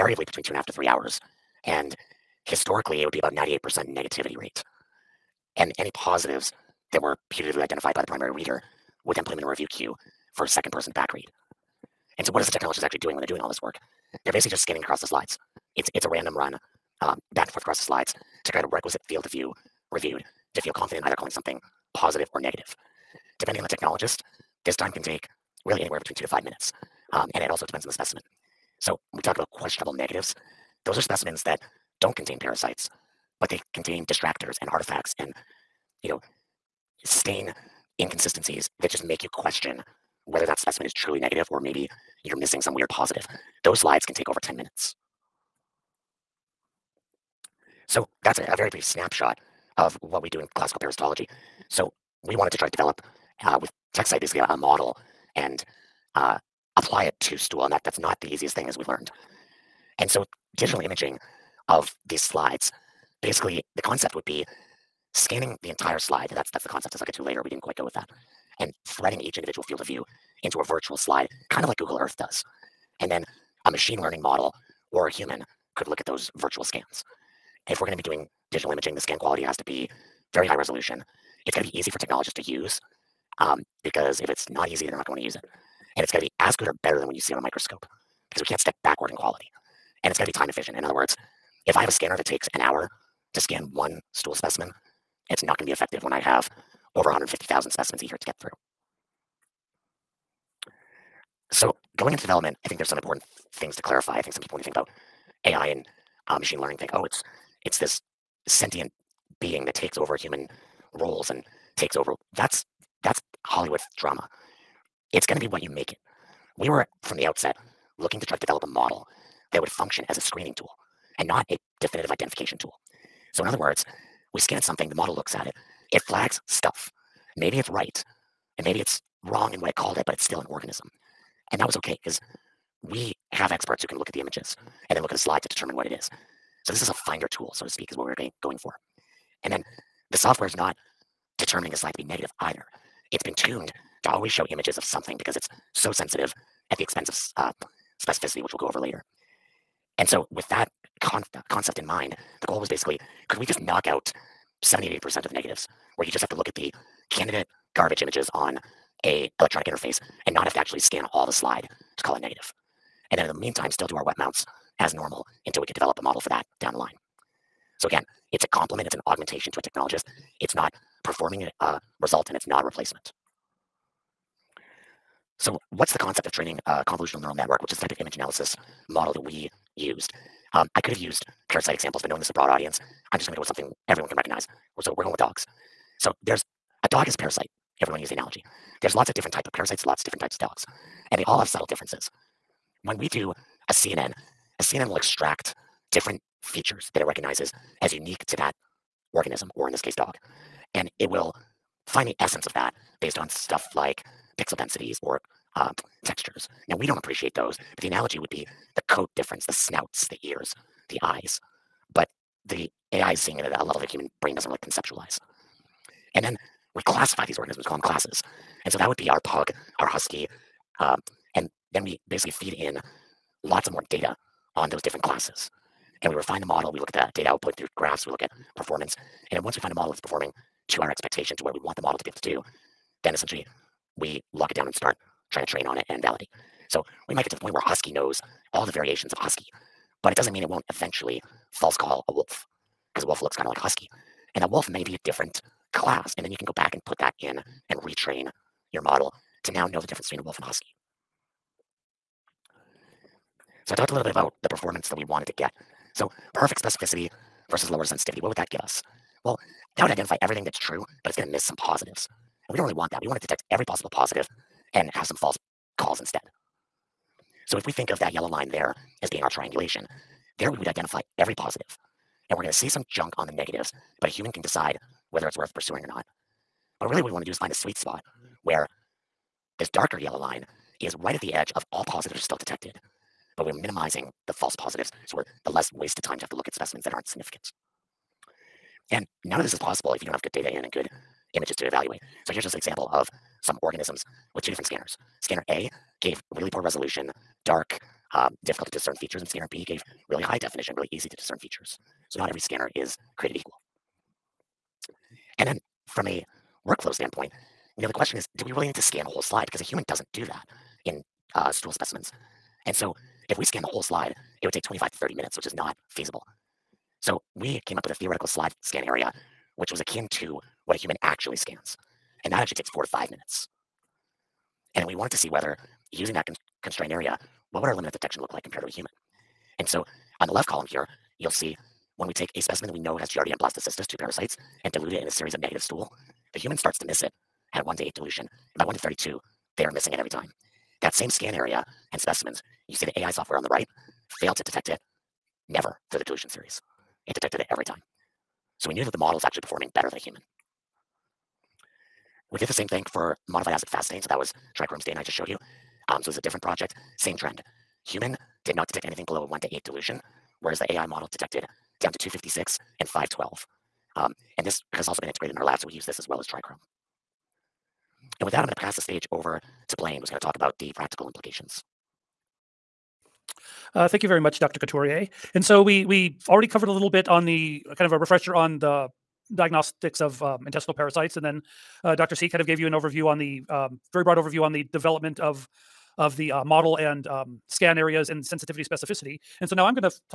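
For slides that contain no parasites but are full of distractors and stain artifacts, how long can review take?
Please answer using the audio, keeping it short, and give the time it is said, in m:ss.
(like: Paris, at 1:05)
over 10 minutes, at 0:44.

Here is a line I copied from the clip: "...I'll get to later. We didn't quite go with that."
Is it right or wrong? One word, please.
right.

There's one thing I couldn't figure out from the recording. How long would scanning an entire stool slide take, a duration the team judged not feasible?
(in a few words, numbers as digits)
25 to 30 minutes.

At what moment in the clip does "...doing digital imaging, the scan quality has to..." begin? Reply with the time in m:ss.
1:18.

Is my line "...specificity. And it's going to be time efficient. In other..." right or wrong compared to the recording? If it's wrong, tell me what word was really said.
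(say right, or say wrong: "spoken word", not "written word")
wrong: "quality", not "specificity".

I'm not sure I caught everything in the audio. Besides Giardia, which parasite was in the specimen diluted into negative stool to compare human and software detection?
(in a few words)
Blastocystis.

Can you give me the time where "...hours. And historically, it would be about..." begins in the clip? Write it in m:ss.
0:00.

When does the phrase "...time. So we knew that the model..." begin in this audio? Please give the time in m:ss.
5:47.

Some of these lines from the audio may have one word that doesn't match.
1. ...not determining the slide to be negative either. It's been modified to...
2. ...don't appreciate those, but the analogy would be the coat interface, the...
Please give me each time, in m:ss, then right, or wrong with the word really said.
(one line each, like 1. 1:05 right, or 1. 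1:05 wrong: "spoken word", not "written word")
1. 2:20 wrong: "tuned", not "modified"
2. 3:26 wrong: "difference", not "interface".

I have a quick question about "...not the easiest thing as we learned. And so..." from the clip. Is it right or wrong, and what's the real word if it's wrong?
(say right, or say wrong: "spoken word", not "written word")
right.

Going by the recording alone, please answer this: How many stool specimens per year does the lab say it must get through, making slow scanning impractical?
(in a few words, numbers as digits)
over 150,000.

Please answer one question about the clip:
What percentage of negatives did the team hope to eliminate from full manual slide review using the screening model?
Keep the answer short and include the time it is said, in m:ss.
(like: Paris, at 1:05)
78%, at 2:34.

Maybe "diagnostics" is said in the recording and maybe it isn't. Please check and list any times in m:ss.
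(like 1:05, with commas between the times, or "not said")
6:19.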